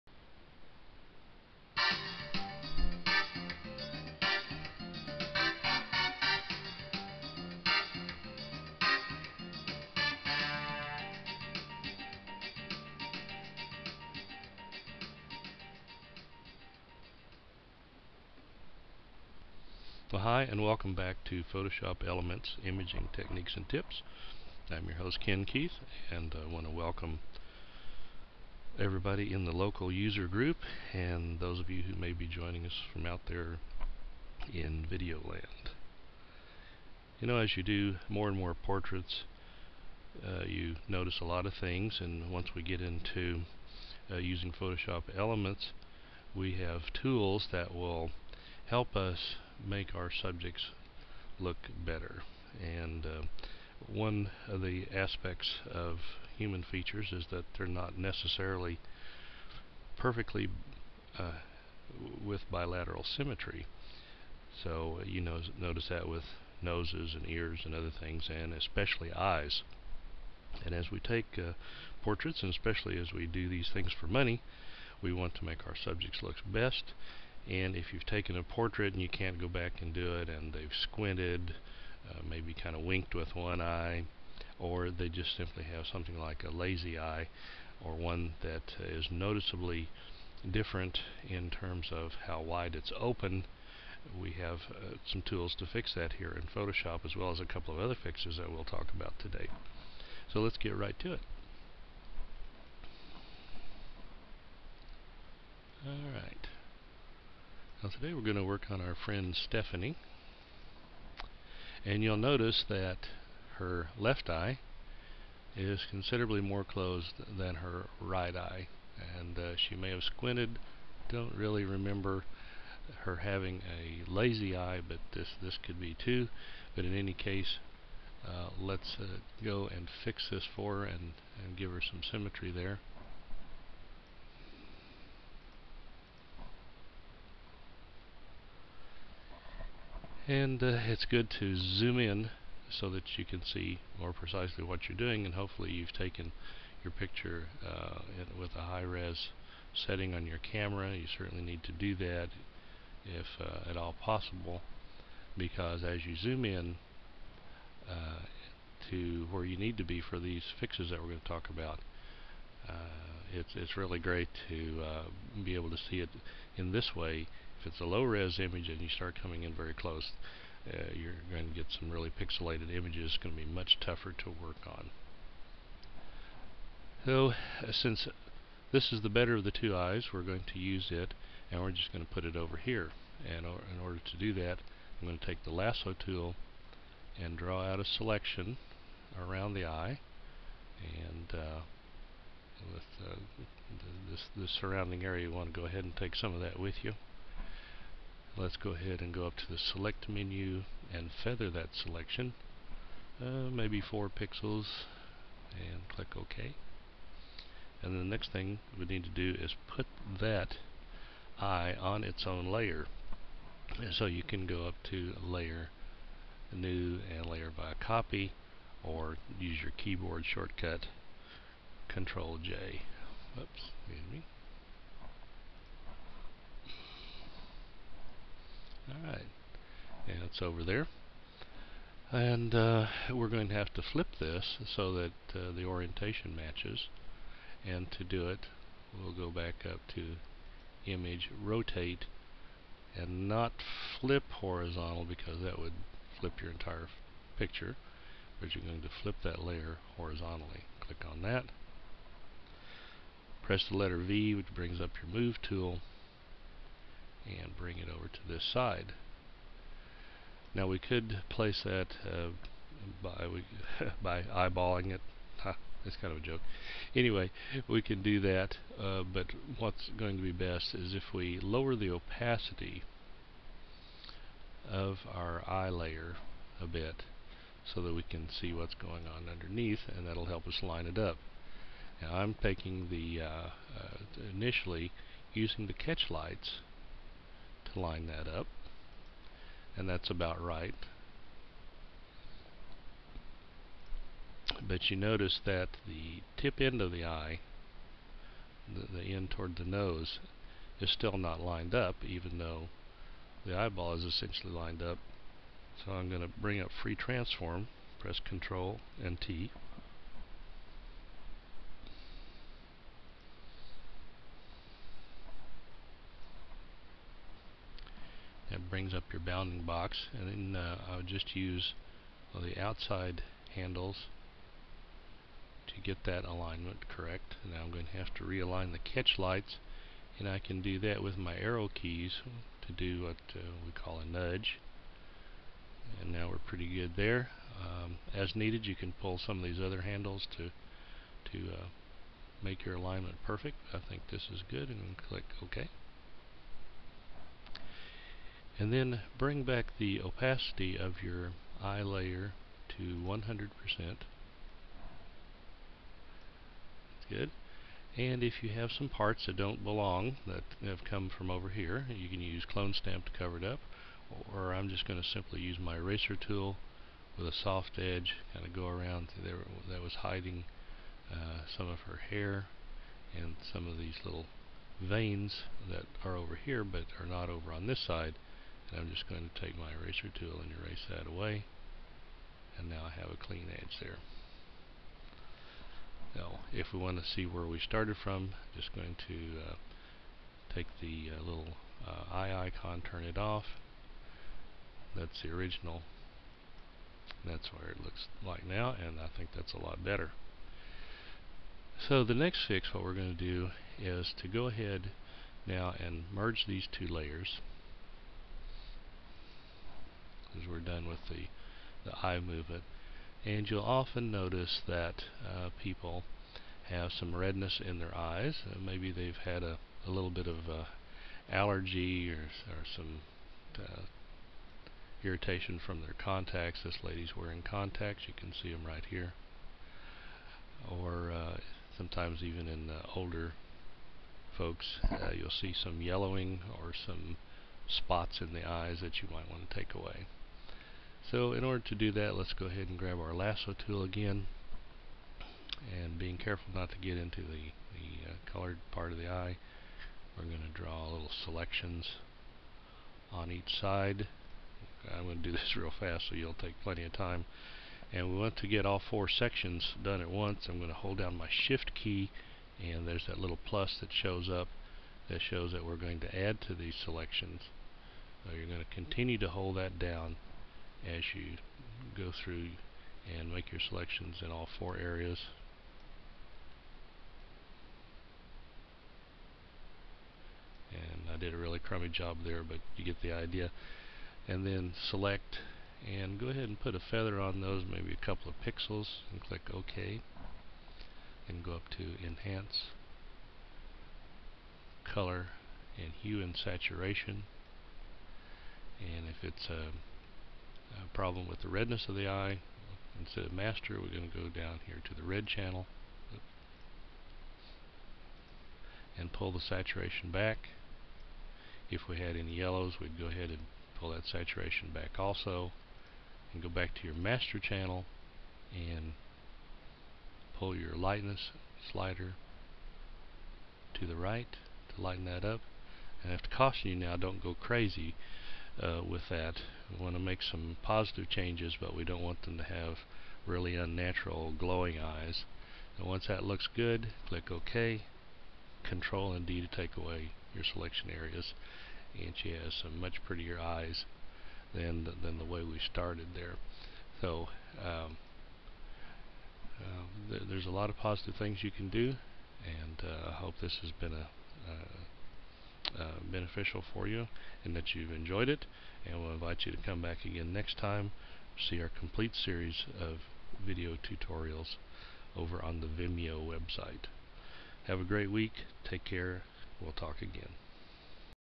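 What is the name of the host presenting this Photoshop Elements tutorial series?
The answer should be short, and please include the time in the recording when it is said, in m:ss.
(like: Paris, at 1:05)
Ken Keith, at 0:25.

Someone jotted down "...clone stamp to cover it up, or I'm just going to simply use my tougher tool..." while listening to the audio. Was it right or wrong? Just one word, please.
wrong.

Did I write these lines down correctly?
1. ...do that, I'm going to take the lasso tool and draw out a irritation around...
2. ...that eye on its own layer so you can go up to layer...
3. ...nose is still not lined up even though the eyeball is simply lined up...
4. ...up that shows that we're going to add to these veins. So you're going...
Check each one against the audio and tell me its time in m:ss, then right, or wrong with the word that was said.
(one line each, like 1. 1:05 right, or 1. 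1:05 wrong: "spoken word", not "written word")
1. 3:04 wrong: "selection", not "irritation"
2. 3:30 right
3. 4:59 wrong: "essentially", not "simply"
4. 7:44 wrong: "selections", not "veins".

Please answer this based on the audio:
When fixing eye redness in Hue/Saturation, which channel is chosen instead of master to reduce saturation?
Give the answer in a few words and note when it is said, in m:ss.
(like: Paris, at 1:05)
red channel, at 8:25.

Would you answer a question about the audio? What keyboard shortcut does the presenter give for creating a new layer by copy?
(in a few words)
Control J.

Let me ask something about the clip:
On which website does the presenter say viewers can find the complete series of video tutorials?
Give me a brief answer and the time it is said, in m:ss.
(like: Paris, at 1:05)
Vimeo, at 9:25.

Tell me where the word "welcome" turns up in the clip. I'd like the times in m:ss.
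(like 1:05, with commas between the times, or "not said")
0:20, 0:26.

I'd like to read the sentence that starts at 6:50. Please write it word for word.
As we're done with the, the eye movement.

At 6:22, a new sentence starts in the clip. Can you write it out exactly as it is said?
And now I have a clean edge there.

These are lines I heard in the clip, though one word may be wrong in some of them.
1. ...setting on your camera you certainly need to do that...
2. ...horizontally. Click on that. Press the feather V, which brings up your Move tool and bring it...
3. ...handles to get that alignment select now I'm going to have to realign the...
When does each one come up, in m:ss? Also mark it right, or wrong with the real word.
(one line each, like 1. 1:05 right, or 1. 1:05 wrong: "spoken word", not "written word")
1. 2:29 right
2. 4:09 wrong: "letter", not "feather"
3. 5:23 wrong: "correct", not "select".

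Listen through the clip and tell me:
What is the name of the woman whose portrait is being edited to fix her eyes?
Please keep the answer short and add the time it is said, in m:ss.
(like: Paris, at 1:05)
Stephanie, at 1:49.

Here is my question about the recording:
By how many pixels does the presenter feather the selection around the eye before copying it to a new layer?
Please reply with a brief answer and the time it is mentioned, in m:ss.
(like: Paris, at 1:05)
4, at 3:23.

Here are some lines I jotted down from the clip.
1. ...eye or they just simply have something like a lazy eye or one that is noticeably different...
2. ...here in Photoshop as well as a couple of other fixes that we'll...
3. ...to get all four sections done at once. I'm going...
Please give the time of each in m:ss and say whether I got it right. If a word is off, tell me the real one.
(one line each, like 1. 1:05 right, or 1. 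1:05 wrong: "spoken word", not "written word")
1. 1:23 right
2. 1:36 right
3. 7:38 right.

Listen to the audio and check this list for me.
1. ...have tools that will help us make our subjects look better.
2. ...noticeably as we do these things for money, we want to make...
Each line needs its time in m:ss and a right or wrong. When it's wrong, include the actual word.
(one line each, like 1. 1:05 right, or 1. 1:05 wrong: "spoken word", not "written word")
1. 0:46 right
2. 1:12 wrong: "especially", not "noticeably".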